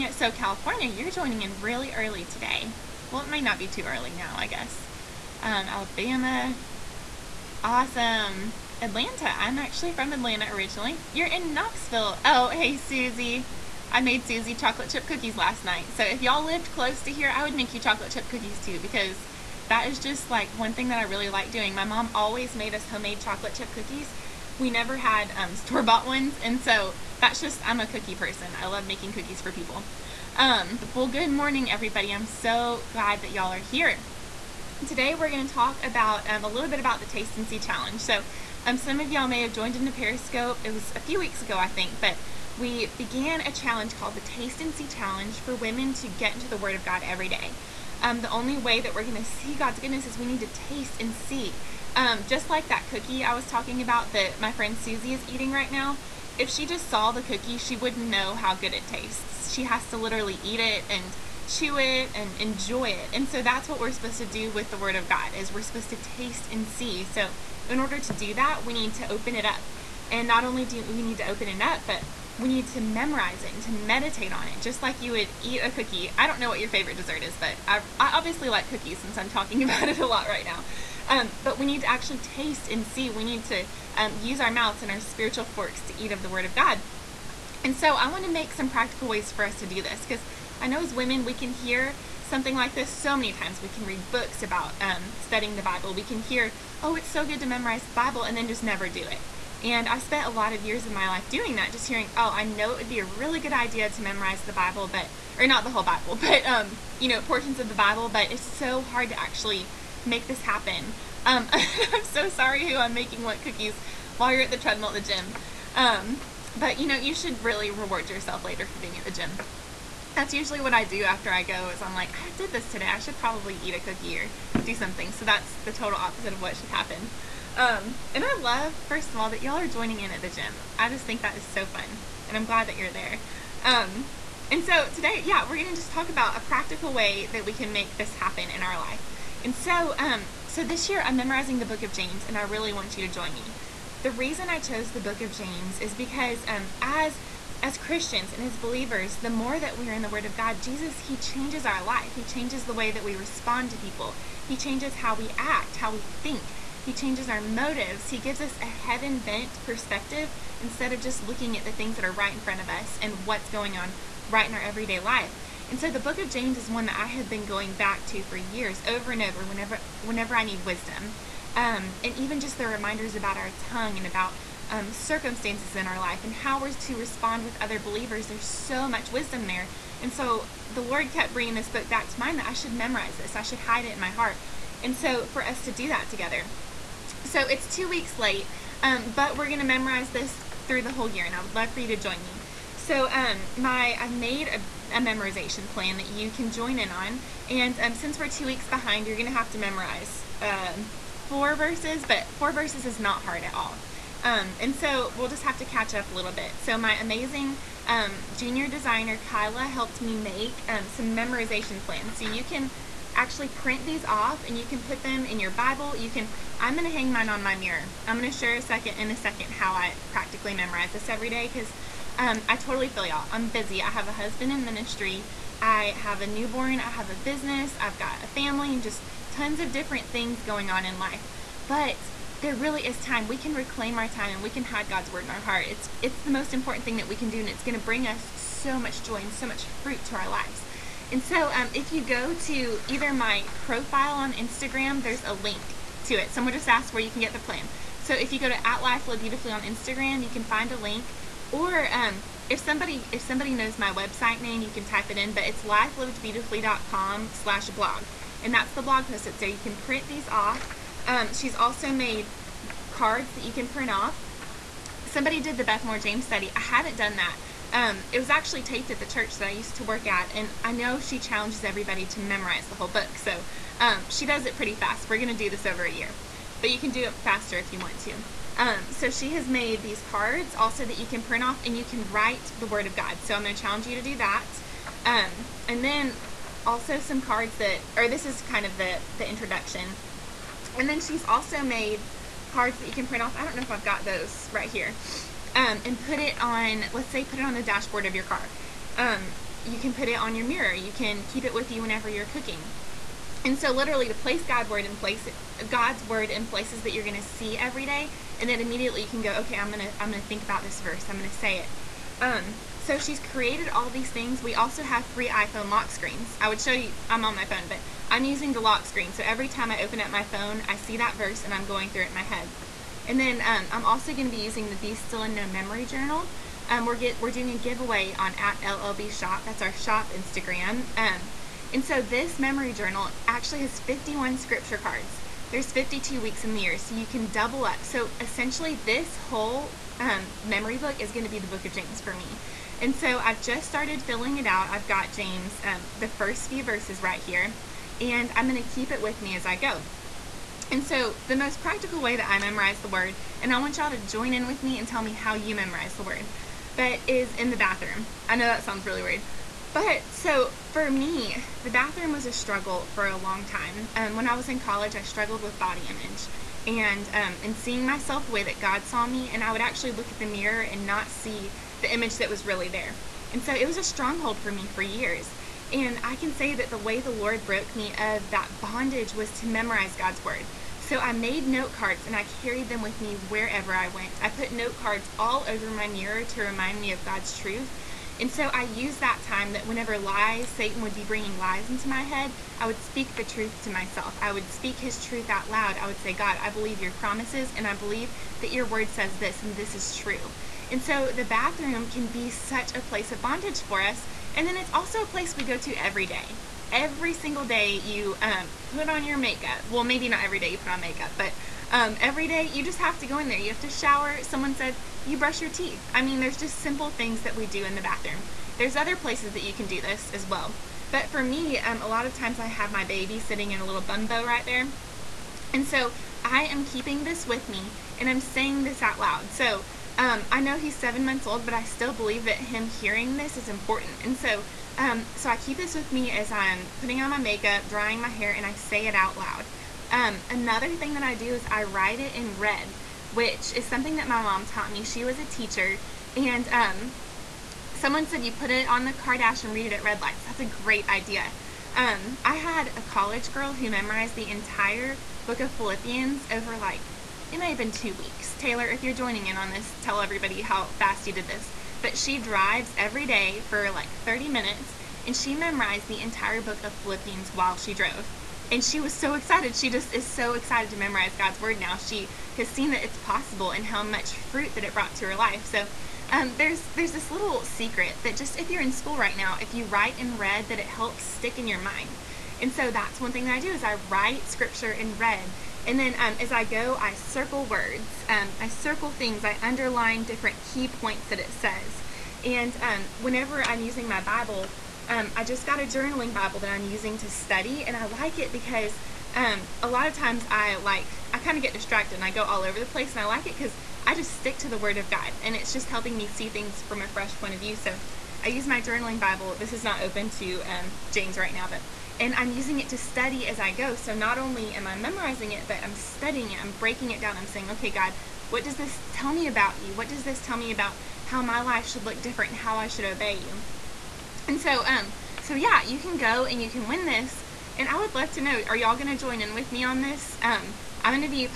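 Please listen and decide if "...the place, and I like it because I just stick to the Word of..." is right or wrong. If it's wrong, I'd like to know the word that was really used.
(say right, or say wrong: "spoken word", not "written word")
right.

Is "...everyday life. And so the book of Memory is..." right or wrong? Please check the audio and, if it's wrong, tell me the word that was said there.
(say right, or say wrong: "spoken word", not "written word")
wrong: "James", not "Memory".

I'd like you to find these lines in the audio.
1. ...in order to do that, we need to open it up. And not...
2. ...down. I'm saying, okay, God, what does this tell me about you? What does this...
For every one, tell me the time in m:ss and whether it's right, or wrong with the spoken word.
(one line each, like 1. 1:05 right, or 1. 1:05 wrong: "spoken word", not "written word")
1. 1:07 right
2. 8:37 right.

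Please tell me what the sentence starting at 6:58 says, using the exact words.
There's other places that you can do this as well.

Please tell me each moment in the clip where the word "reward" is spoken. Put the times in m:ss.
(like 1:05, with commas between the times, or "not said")
1:57.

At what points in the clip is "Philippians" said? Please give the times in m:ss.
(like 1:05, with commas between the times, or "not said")
7:35, 7:46.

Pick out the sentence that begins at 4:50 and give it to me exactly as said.
And then she's also made cards that you can print off.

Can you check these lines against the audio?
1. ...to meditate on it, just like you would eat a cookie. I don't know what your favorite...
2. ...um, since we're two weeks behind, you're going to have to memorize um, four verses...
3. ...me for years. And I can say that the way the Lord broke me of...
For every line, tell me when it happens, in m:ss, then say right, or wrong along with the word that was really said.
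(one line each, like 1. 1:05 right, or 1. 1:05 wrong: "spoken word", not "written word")
1. 1:13 right
2. 3:17 right
3. 6:14 right.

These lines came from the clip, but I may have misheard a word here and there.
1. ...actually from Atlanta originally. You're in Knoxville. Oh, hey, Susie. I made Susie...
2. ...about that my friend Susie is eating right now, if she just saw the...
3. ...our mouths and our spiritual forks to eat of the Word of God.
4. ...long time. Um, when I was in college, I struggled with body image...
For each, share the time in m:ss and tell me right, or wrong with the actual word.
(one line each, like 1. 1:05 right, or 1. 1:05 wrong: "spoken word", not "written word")
1. 0:09 right
2. 0:53 right
3. 1:24 right
4. 6:03 right.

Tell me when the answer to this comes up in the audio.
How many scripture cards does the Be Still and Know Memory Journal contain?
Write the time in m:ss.
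5:33.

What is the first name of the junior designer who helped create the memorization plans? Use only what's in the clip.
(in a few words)
Kyla.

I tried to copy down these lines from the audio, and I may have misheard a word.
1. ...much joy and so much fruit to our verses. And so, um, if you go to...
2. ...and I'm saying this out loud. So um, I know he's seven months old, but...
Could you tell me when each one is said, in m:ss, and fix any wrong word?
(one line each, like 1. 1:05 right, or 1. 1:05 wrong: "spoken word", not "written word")
1. 3:58 wrong: "lives", not "verses"
2. 7:07 right.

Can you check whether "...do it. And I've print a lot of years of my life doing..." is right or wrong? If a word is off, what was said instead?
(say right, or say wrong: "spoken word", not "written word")
wrong: "spent", not "print".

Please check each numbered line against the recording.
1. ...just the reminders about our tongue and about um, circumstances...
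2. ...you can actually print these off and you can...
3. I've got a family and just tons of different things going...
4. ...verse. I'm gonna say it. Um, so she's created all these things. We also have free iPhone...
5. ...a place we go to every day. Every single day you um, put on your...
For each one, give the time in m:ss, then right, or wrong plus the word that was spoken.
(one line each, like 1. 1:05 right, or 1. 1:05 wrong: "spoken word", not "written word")
1. 2:52 right
2. 3:32 right
3. 3:47 right
4. 5:10 right
5. 6:45 right.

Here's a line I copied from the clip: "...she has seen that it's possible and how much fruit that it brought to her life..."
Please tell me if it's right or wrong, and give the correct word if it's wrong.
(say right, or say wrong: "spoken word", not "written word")
right.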